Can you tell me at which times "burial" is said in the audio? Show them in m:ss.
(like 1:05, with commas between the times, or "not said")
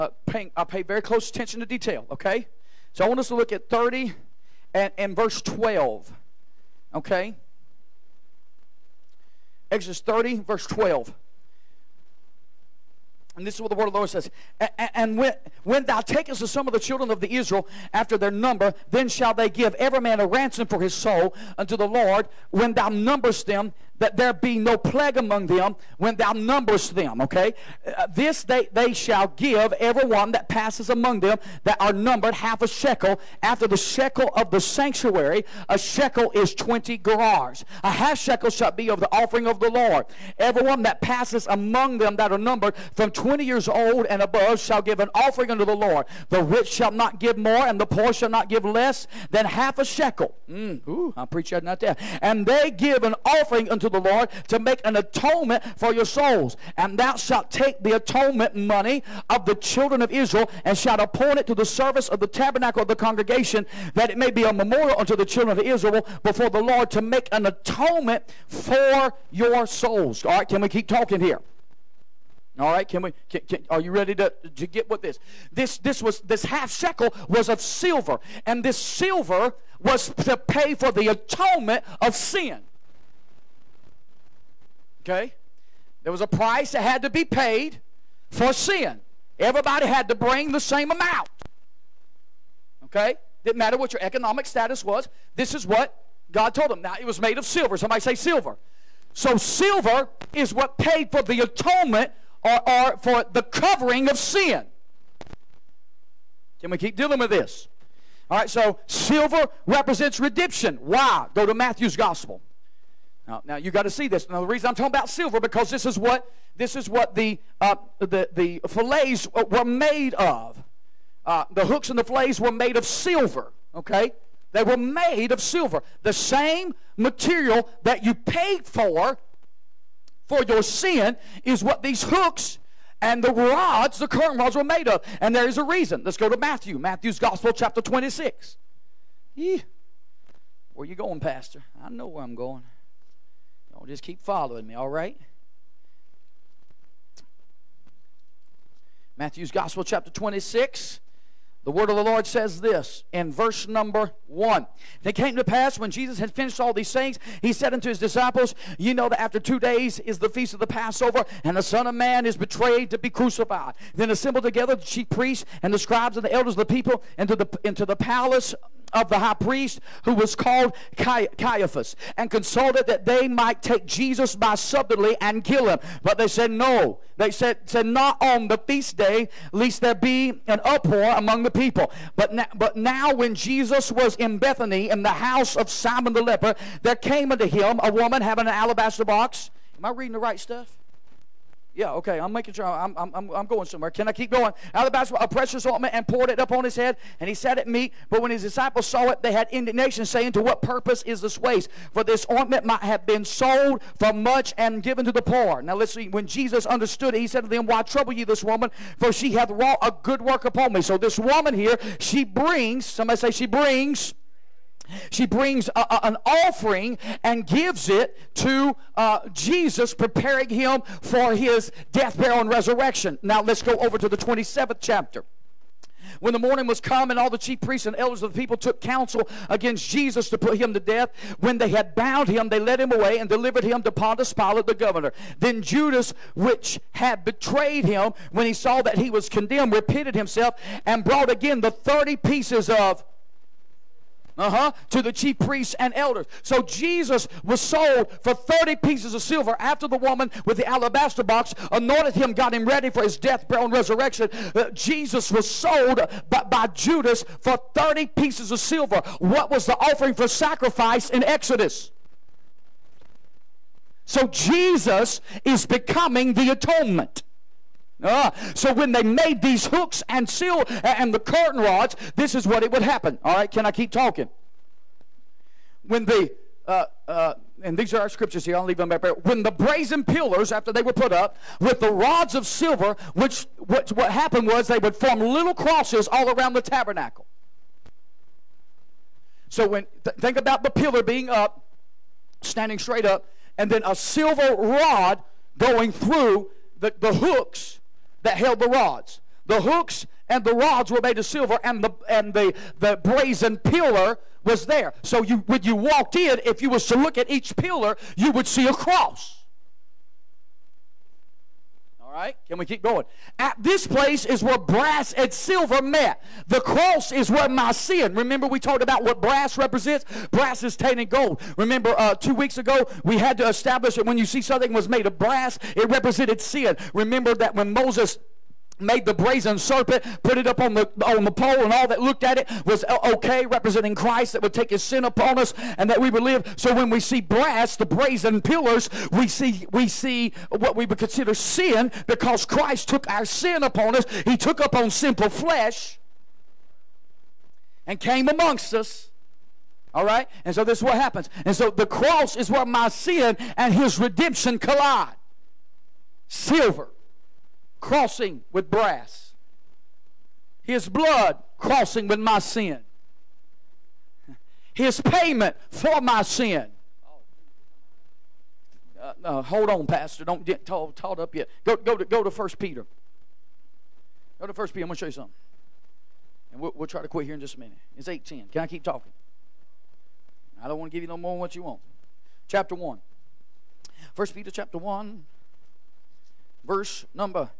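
3:42, 4:13.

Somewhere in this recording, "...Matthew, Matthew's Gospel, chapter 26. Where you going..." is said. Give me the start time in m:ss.
2:16.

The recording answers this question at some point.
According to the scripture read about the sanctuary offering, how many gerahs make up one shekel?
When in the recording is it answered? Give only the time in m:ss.
0:36.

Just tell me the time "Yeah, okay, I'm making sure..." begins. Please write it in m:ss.
3:11.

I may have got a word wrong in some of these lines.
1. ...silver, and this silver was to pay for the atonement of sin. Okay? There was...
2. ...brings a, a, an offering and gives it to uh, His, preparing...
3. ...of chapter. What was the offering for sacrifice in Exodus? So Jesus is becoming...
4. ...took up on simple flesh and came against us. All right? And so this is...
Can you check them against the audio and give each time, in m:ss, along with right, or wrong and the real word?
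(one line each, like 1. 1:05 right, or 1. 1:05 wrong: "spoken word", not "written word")
1. 1:17 right
2. 3:35 wrong: "Jesus", not "His"
3. 4:18 wrong: "silver", not "chapter"
4. 5:44 wrong: "amongst", not "against".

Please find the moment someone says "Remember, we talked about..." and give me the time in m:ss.
5:18.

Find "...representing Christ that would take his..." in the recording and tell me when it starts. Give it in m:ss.
5:33.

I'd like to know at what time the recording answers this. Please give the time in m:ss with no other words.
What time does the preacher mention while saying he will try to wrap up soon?
6:18.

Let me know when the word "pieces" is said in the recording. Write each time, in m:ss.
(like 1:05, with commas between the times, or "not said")
4:02, 4:08, 4:18.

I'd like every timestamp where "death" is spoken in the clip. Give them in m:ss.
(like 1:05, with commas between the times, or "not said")
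3:41, 3:50, 4:13.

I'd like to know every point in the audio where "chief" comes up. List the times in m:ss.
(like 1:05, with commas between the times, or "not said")
2:44, 3:47, 4:05.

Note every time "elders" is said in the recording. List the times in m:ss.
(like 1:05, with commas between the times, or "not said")
2:46, 3:47, 4:05.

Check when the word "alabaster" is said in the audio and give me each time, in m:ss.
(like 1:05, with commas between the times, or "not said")
3:08, 4:10.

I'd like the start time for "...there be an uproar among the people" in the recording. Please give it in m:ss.
2:59.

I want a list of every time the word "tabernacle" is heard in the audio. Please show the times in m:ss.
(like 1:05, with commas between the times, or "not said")
1:02, 4:46.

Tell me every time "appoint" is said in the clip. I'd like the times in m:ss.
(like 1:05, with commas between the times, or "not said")
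1:00.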